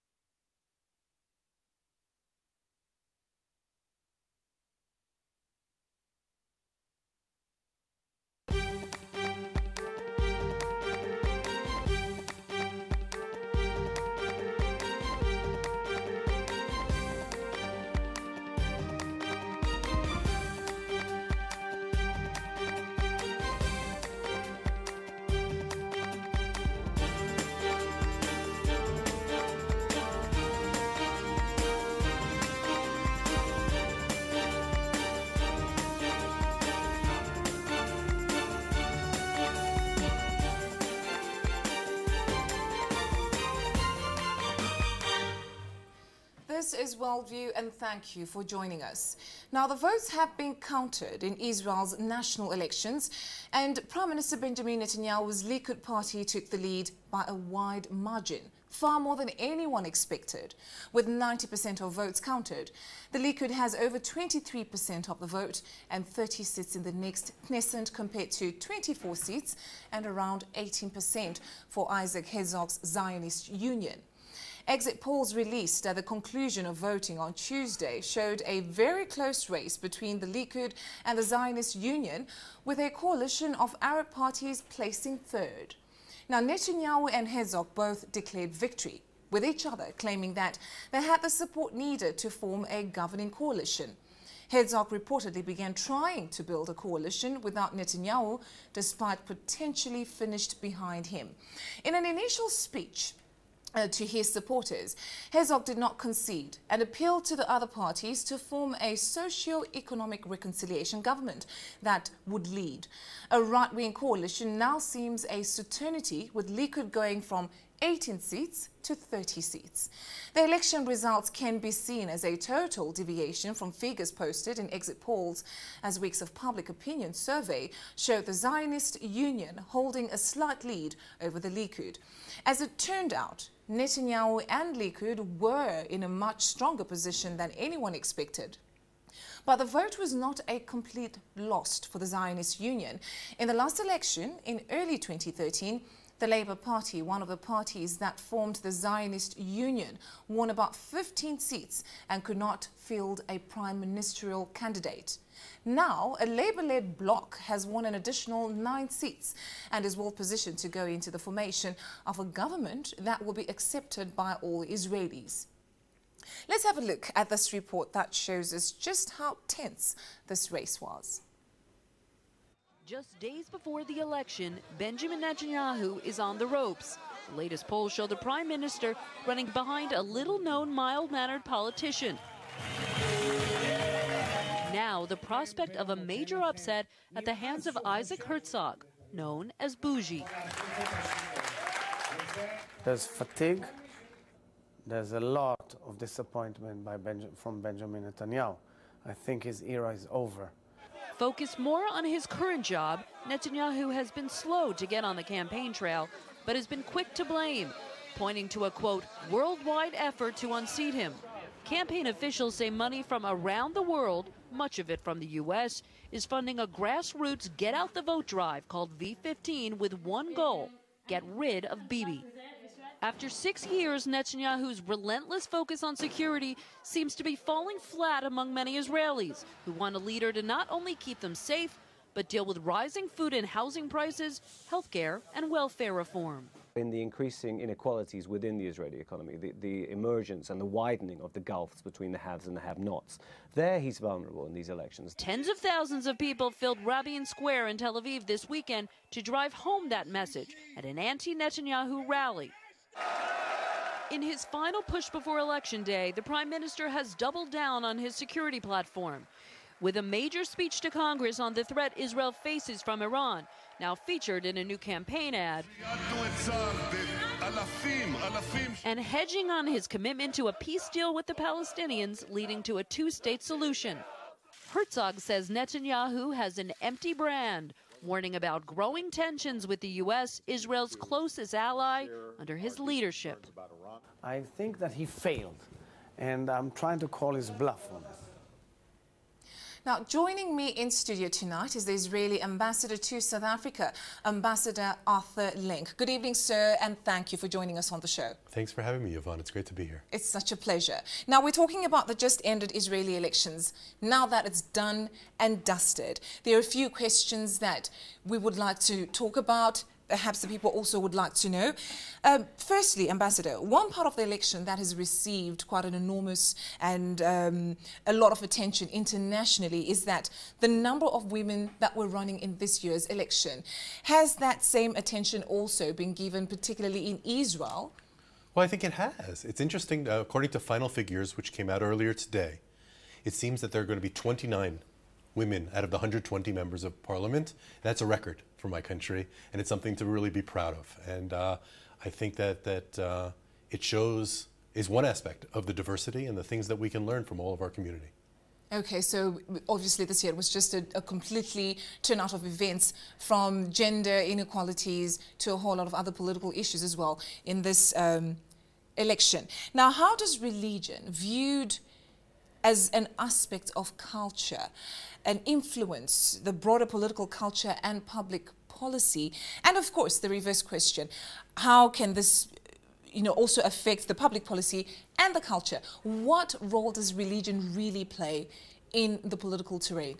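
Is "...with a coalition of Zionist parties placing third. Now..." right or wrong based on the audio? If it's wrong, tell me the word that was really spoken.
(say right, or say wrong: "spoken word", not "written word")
wrong: "Arab", not "Zionist".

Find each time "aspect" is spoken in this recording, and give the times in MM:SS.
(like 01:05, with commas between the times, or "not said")
05:45, 06:03.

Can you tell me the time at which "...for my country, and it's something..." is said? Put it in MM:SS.
05:38.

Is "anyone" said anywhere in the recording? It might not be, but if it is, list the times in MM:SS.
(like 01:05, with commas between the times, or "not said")
00:59, 02:17.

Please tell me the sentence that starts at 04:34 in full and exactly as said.
Herzog says Netanyahu has an empty brand warning about growing tensions with the U.S., Israel's closest ally, under his leadership.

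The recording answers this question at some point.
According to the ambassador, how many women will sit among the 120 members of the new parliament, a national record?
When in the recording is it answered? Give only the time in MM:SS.
05:34.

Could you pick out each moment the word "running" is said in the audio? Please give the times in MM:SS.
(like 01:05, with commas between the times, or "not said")
02:59, 05:22.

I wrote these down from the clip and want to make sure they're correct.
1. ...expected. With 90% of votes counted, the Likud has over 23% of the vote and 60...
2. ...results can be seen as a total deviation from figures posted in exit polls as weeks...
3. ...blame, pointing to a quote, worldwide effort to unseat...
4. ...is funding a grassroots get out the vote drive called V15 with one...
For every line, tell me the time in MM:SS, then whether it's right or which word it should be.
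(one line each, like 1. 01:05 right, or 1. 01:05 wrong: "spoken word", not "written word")
1. 00:59 wrong: "30", not "60"
2. 02:00 right
3. 03:27 right
4. 03:36 right.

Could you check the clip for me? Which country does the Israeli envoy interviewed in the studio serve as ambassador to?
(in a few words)
South Africa.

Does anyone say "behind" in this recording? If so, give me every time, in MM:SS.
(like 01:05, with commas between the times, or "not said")
01:40, 02:59.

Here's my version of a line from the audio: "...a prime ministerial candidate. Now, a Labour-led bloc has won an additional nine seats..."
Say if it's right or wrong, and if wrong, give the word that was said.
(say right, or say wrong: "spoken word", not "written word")
right.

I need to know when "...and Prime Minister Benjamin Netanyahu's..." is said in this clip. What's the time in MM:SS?
00:53.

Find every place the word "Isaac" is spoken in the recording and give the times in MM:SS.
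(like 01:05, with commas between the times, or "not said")
01:11, 03:07.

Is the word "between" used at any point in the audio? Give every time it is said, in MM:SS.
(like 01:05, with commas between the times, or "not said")
01:19, 04:01.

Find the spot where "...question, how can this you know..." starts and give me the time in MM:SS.
06:10.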